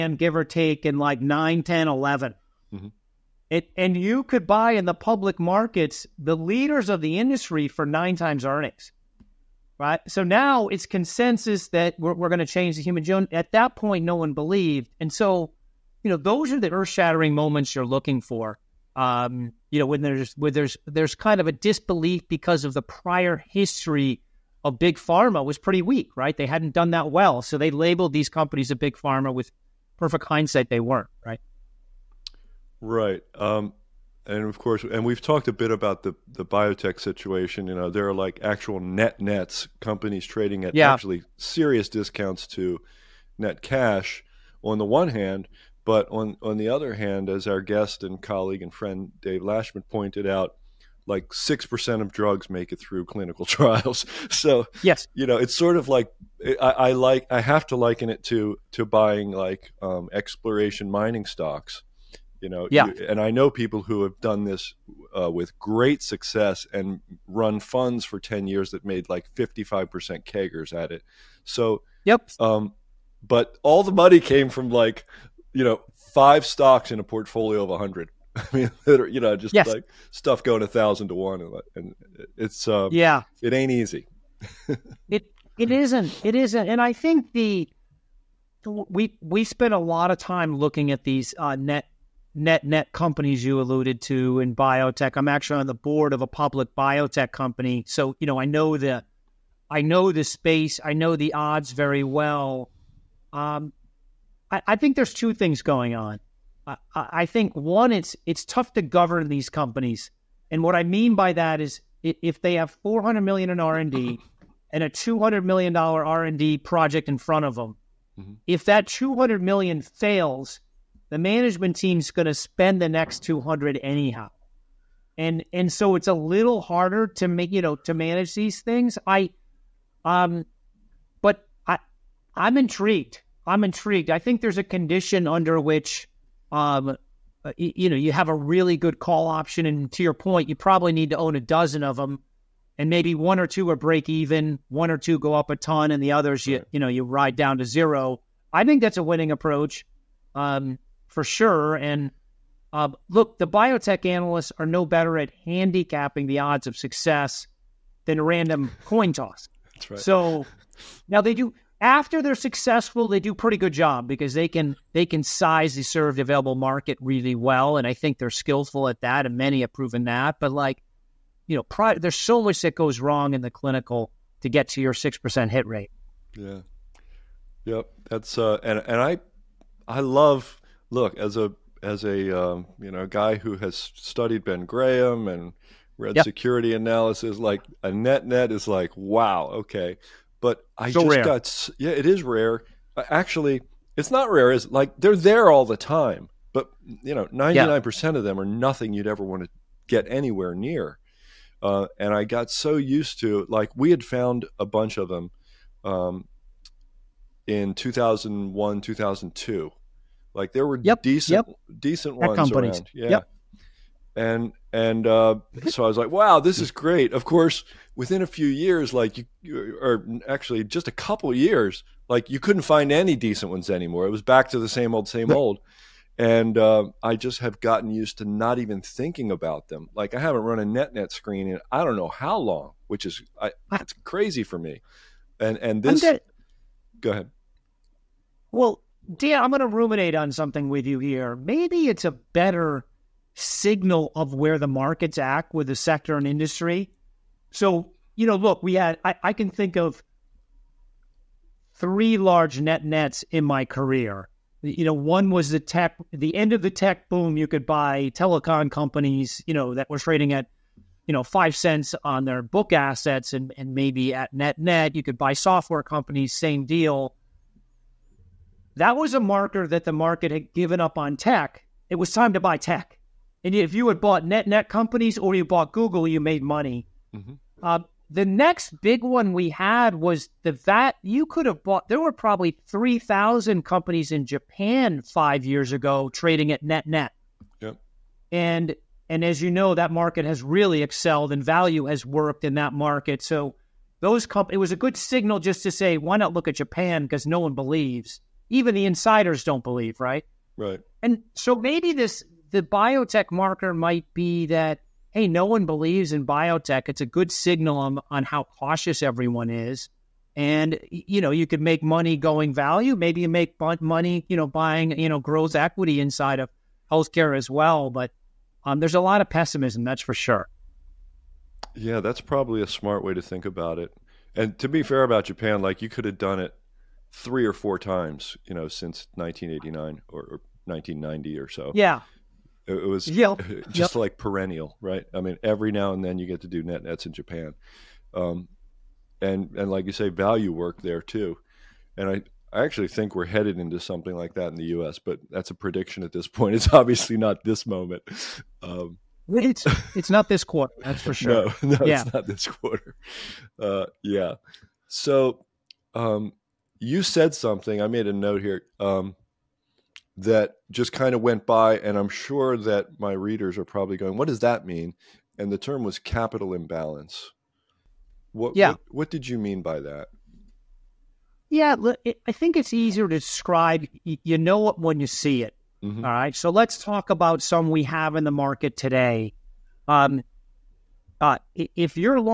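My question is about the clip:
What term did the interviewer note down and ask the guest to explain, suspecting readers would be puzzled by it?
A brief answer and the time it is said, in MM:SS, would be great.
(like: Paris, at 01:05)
capital imbalance, at 06:05.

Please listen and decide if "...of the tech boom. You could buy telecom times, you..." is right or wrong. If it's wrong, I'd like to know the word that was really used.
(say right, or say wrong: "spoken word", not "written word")
wrong: "companies", not "times".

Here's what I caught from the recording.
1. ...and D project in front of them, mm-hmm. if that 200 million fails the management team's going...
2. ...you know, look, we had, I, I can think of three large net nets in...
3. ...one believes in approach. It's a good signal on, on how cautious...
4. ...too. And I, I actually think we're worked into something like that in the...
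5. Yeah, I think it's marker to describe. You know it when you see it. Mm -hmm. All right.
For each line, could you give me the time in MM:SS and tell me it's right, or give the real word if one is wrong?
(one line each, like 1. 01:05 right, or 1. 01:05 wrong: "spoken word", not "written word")
1. 01:56 right
2. 04:08 right
3. 05:05 wrong: "biotech", not "approach"
4. 05:41 wrong: "headed", not "worked"
5. 06:11 wrong: "easier", not "marker".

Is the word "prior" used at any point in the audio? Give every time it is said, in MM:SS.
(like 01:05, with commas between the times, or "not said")
00:22.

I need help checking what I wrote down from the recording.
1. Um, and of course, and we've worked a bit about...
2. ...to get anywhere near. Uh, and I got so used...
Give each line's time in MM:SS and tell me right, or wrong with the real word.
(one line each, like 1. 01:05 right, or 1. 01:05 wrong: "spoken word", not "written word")
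1. 00:33 wrong: "talked", not "worked"
2. 03:19 right.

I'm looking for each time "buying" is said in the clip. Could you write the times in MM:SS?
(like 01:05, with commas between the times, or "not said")
00:58, 05:14.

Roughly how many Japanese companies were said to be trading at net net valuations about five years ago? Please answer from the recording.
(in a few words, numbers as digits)
3,000.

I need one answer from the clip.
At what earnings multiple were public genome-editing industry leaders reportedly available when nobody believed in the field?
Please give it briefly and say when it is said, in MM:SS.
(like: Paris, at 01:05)
9 times earnings, at 00:07.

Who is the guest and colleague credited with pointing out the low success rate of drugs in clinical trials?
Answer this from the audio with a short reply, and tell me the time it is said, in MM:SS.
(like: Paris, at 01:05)
Dave Lashmet, at 00:49.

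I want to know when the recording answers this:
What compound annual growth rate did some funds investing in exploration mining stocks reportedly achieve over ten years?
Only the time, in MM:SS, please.
01:09.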